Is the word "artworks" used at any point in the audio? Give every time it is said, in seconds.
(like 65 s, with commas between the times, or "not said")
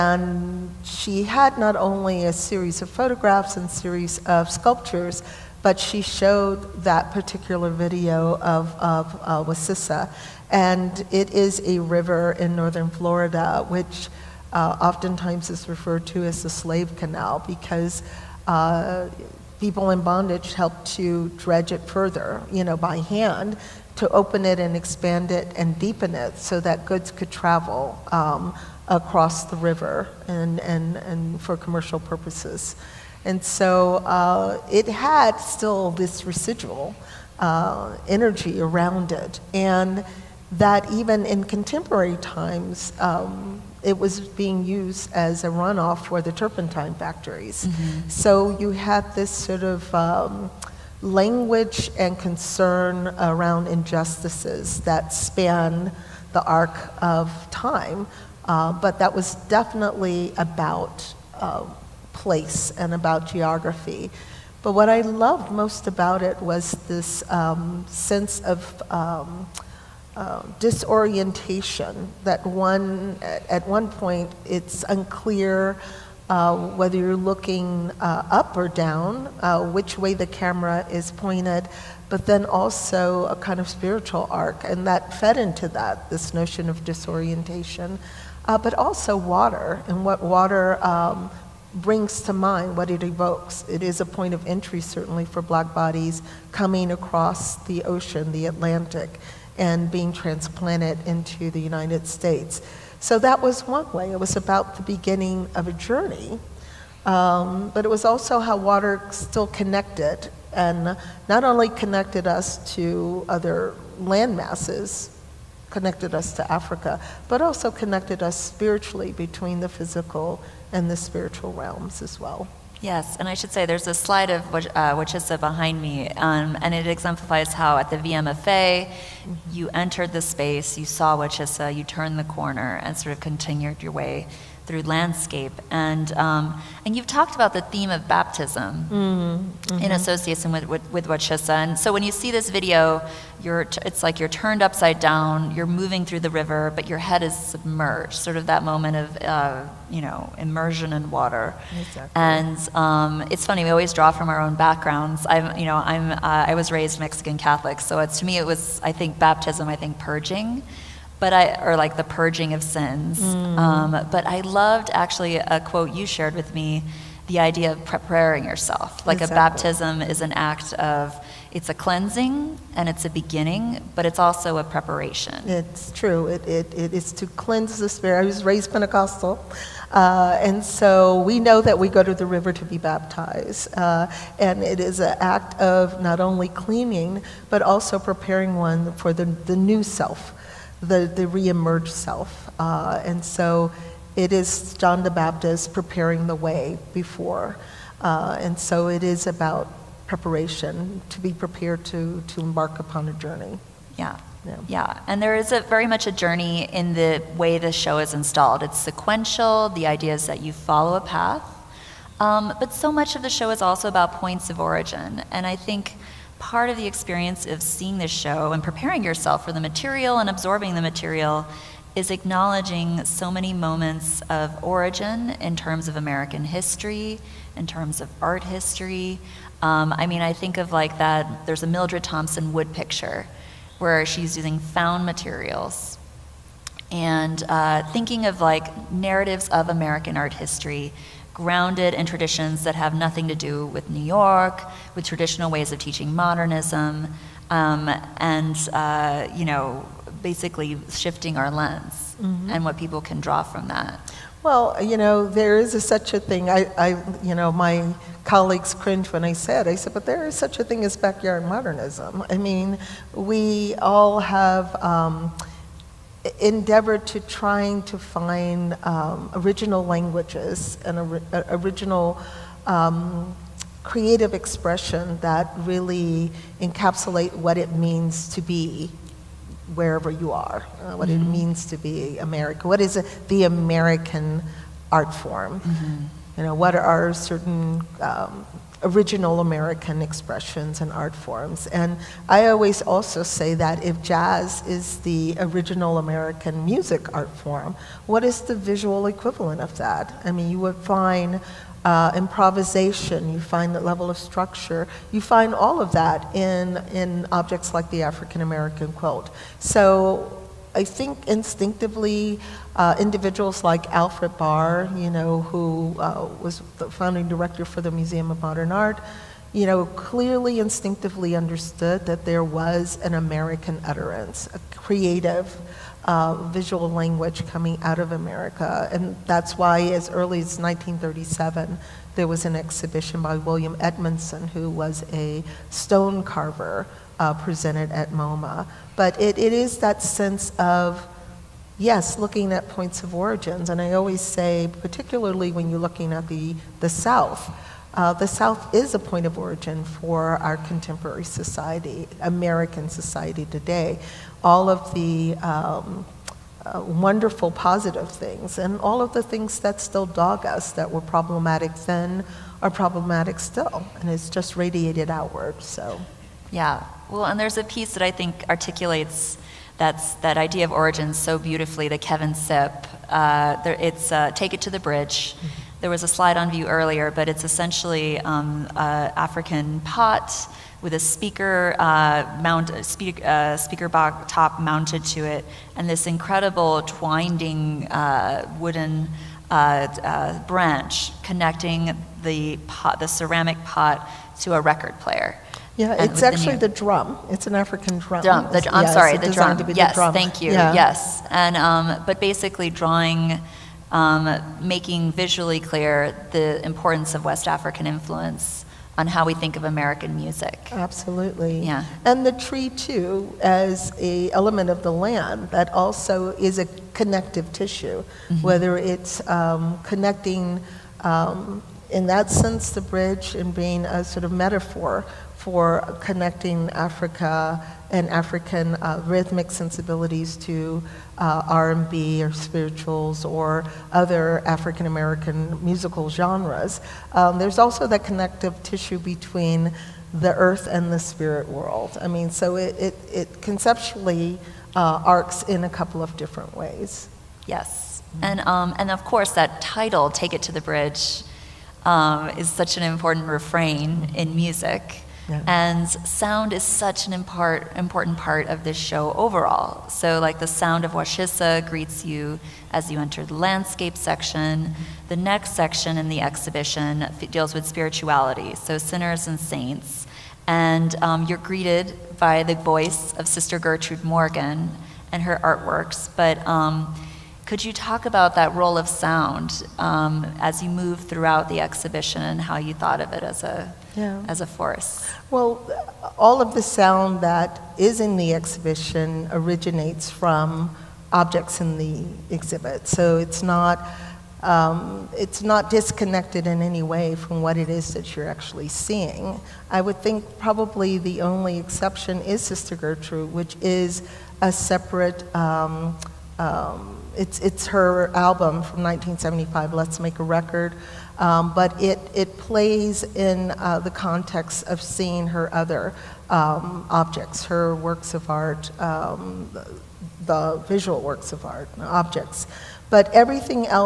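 475 s.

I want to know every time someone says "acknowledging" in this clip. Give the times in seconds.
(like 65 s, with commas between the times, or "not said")
222 s.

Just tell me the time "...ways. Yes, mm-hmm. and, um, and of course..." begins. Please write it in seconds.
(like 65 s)
446 s.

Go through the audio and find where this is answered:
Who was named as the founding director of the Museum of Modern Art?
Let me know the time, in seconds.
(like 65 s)
313 s.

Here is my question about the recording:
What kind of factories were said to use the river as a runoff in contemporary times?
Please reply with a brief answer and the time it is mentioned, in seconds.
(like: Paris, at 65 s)
turpentine factories, at 46 s.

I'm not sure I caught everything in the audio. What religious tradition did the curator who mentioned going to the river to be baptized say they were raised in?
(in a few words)
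Pentecostal.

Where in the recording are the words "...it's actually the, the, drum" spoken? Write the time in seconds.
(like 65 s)
396 s.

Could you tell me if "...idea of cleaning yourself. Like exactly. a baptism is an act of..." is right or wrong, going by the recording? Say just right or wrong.
wrong.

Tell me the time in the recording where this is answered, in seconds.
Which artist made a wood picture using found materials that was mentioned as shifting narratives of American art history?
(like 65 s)
231 s.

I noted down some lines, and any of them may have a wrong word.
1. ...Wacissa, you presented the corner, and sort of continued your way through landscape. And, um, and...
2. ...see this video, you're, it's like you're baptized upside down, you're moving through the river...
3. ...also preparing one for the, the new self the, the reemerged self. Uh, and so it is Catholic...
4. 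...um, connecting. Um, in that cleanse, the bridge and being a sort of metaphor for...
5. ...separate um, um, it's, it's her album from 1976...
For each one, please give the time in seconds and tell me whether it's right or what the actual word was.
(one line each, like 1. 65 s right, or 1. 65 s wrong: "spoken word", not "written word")
1. 131 s wrong: "turned", not "presented"
2. 142 s wrong: "turned", not "baptized"
3. 187 s wrong: "John", not "Catholic"
4. 419 s wrong: "sense", not "cleanse"
5. 504 s wrong: "1975", not "1976".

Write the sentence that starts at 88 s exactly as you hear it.
Uh, but also water and what water um, brings to mind what it evokes.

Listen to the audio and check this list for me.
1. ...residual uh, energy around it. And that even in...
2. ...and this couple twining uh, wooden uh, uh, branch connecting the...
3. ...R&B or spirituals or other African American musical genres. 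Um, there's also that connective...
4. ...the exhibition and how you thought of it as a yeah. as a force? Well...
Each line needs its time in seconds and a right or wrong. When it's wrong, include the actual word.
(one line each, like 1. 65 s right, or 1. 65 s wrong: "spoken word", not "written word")
1. 36 s right
2. 385 s wrong: "incredible", not "couple"
3. 431 s right
4. 481 s right.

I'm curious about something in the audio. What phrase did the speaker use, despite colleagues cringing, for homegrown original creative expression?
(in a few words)
backyard modernism.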